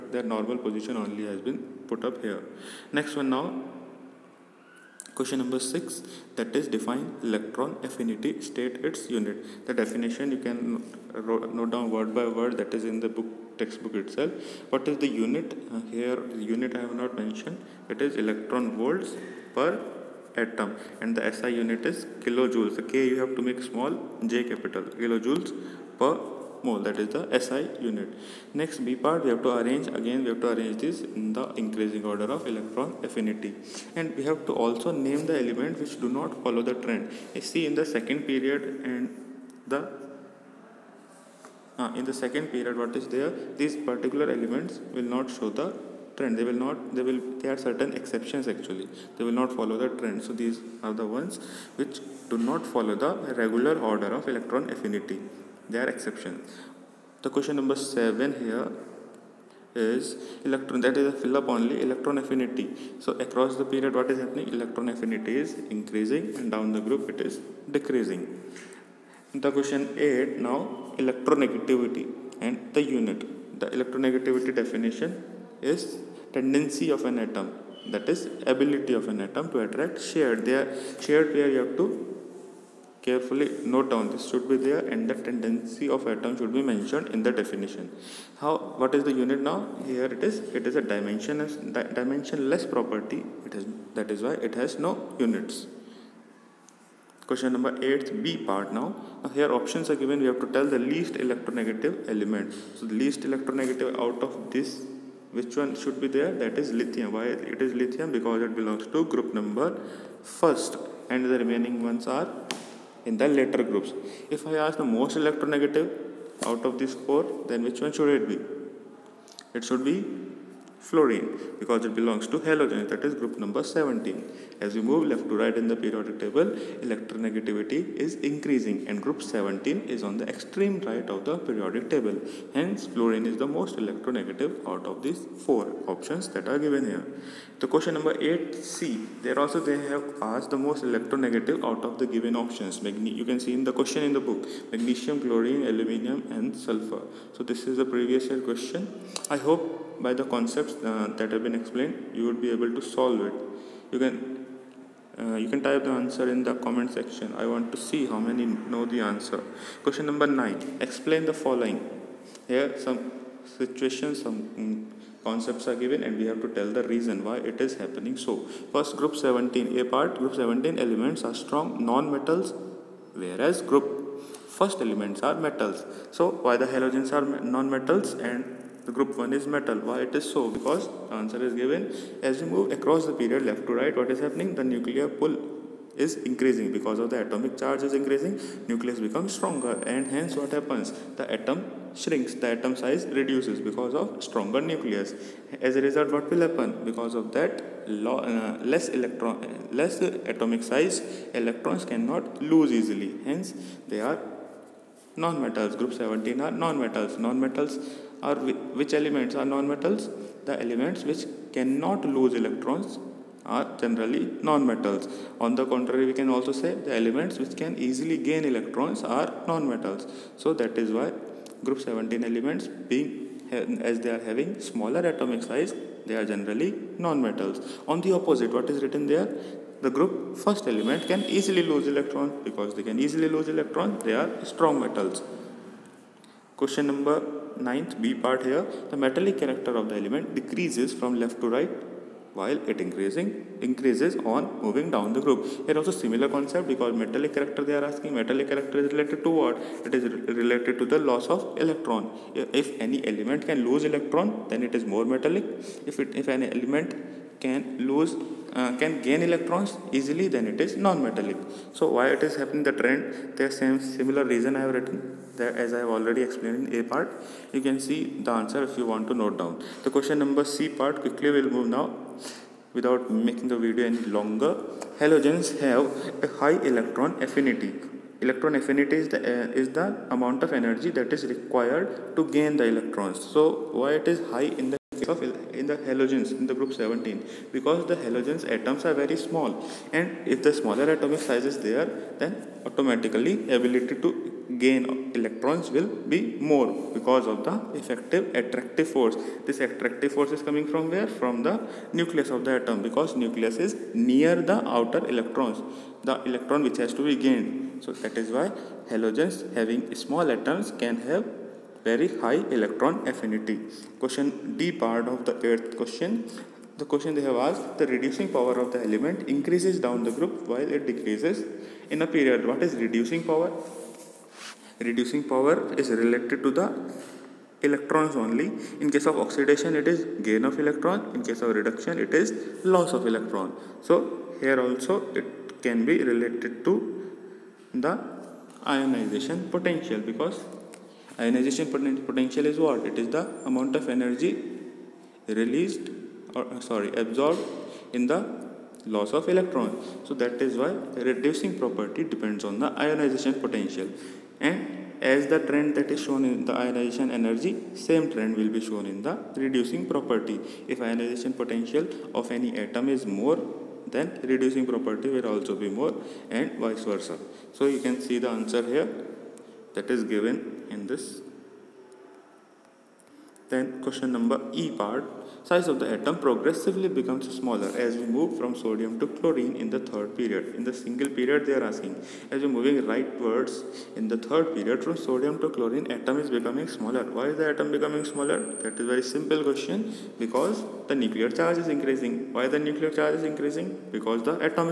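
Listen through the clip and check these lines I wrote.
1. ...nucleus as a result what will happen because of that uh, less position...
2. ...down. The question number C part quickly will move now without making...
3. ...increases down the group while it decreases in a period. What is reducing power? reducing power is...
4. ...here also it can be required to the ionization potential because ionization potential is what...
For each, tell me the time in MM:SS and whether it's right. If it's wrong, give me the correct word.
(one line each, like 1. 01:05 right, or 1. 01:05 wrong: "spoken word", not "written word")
1. 03:14 wrong: "electron", not "position"
2. 04:29 right
3. 05:19 right
4. 05:34 wrong: "related", not "required".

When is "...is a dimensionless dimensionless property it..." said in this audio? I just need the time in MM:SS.
01:30.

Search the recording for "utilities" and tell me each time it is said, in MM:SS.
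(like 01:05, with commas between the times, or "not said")
not said.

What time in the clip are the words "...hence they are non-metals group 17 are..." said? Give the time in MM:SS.
03:23.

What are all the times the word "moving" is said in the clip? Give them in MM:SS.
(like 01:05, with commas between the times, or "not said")
04:04, 06:22.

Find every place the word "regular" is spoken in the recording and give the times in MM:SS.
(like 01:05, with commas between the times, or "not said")
00:53.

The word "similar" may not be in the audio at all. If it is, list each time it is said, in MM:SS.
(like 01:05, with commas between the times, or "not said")
04:05, 04:23.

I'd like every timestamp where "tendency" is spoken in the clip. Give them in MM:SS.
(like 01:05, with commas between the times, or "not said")
01:16, 01:25.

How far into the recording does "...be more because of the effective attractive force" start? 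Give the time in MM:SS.
04:55.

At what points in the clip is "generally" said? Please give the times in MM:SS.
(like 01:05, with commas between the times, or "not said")
03:33, 03:46.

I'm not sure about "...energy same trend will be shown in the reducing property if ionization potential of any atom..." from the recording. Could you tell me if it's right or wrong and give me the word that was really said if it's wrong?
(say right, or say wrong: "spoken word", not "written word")
right.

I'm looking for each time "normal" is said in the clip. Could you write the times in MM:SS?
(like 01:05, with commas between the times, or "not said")
00:00.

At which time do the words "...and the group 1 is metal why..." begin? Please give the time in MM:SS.
02:58.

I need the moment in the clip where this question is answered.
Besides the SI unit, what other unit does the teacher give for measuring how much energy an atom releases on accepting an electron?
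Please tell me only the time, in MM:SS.
00:18.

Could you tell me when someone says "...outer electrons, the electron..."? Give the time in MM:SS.
05:04.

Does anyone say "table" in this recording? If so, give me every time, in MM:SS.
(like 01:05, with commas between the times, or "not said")
02:06, 02:11.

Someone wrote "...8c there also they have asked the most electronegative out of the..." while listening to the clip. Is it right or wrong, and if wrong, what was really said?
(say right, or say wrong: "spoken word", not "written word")
right.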